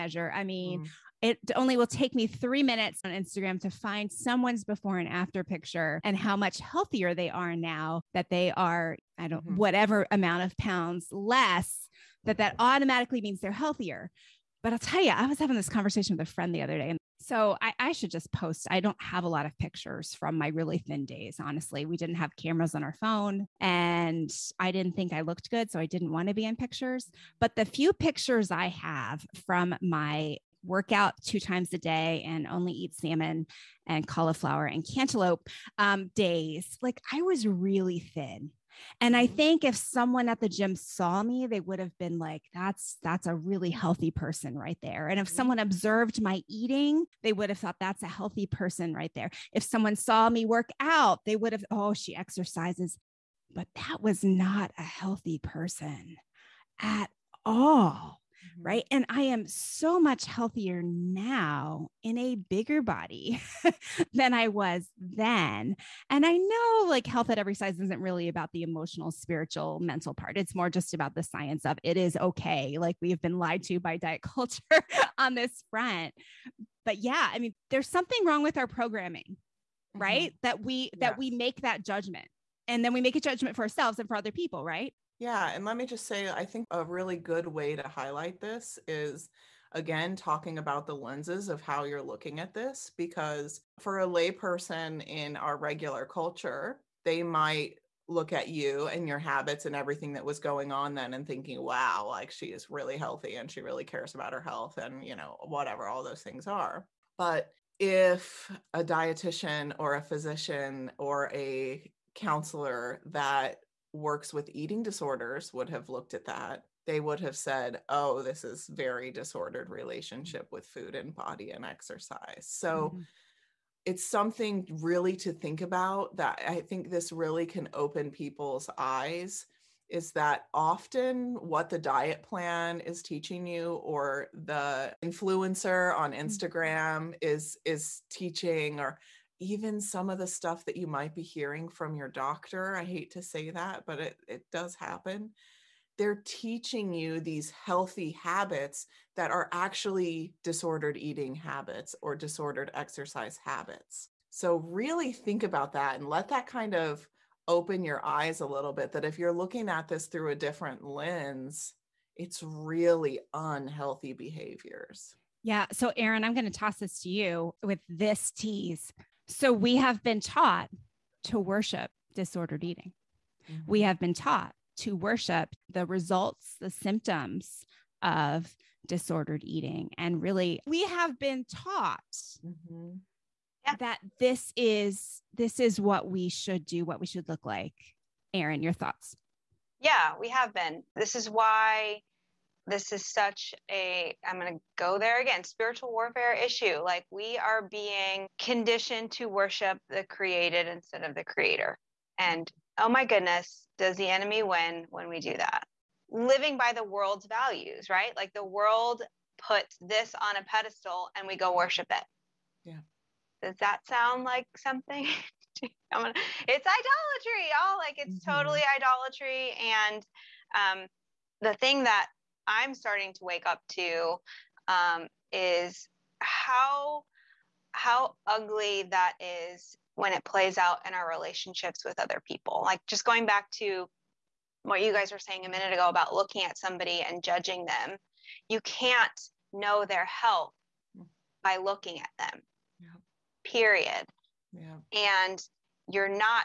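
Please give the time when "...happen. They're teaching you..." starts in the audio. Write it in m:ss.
2:24.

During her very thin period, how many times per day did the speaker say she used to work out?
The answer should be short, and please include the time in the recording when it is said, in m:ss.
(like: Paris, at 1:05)
2, at 0:31.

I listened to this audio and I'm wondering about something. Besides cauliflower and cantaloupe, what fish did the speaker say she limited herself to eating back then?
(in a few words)
salmon.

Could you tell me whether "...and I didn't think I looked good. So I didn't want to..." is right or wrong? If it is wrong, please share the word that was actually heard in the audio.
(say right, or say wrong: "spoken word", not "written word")
right.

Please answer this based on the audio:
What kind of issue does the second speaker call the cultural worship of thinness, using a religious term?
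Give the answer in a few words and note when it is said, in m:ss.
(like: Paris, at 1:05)
spiritual warfare, at 3:15.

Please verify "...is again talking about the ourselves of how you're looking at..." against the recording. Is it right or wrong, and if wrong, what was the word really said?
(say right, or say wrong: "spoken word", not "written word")
wrong: "lenses", not "ourselves".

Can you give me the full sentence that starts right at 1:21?
that we make that judgment and then we make a judgment for ourselves and for other people, right?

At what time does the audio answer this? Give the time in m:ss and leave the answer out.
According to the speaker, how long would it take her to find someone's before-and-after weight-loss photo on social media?
0:02.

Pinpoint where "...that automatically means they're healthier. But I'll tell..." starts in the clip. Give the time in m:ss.
0:12.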